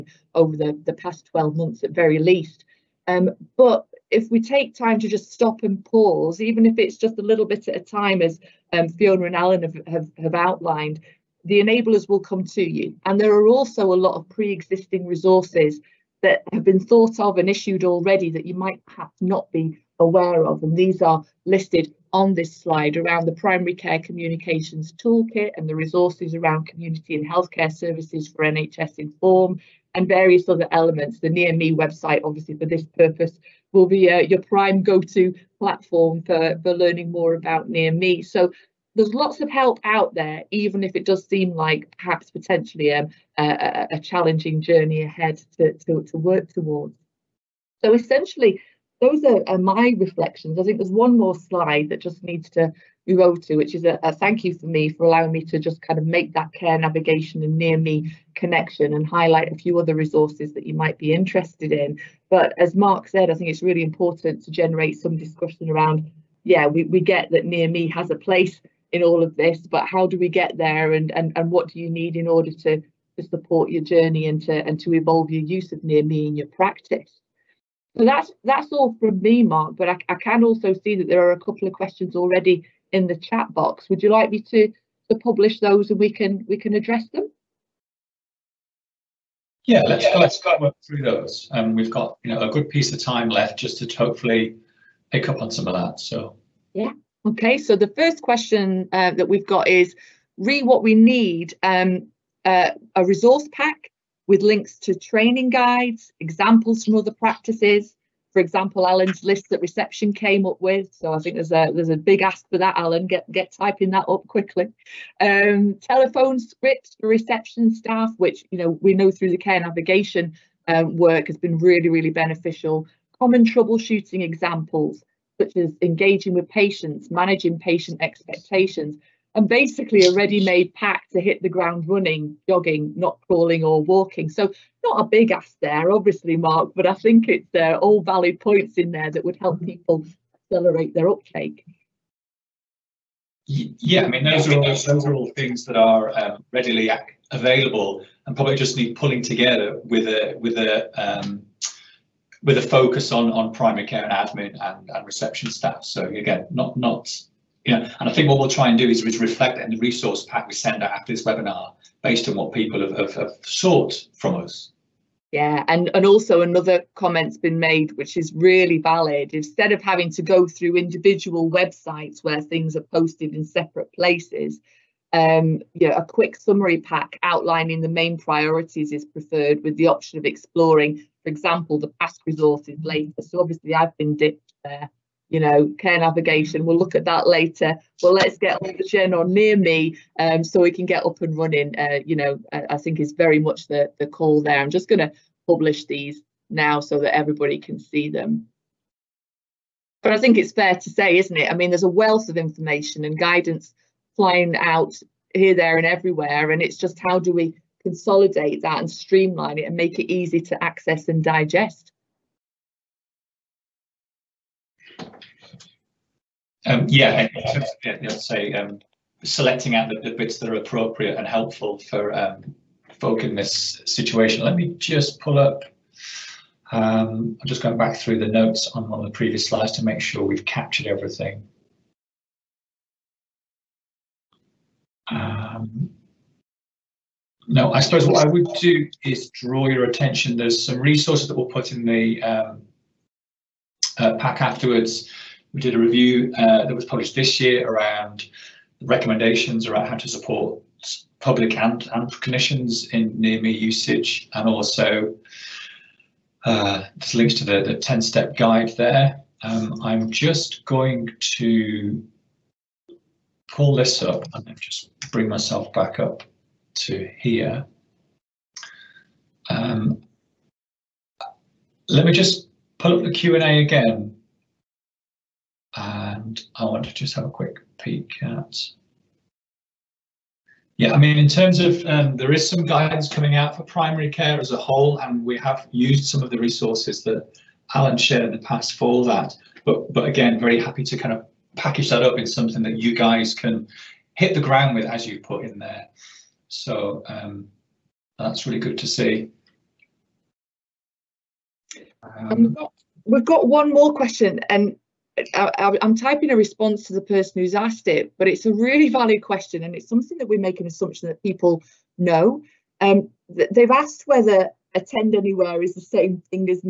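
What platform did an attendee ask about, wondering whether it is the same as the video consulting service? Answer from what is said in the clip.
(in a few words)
Attend Anywhere.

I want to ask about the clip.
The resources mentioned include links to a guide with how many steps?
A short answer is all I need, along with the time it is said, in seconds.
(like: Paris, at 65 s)
10, at 257 s.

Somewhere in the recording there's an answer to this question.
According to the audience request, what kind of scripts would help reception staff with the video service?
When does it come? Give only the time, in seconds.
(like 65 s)
115 s.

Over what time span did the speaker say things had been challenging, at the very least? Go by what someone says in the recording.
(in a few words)
12 months.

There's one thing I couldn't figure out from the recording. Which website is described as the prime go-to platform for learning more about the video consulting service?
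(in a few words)
Near Me website.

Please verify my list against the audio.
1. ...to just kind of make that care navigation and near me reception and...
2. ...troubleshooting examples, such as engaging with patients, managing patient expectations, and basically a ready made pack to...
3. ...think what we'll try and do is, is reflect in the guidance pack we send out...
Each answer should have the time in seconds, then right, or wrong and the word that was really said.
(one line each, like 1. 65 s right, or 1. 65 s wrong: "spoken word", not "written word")
1. 55 s wrong: "connection", not "reception"
2. 123 s right
3. 158 s wrong: "resource", not "guidance".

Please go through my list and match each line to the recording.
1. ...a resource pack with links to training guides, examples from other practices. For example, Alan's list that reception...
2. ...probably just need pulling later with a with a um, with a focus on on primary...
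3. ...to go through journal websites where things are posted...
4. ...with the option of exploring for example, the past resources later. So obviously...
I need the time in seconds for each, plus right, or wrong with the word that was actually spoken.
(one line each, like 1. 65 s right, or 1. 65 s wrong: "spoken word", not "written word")
1. 102 s right
2. 148 s wrong: "together", not "later"
3. 170 s wrong: "individual", not "journal"
4. 179 s right.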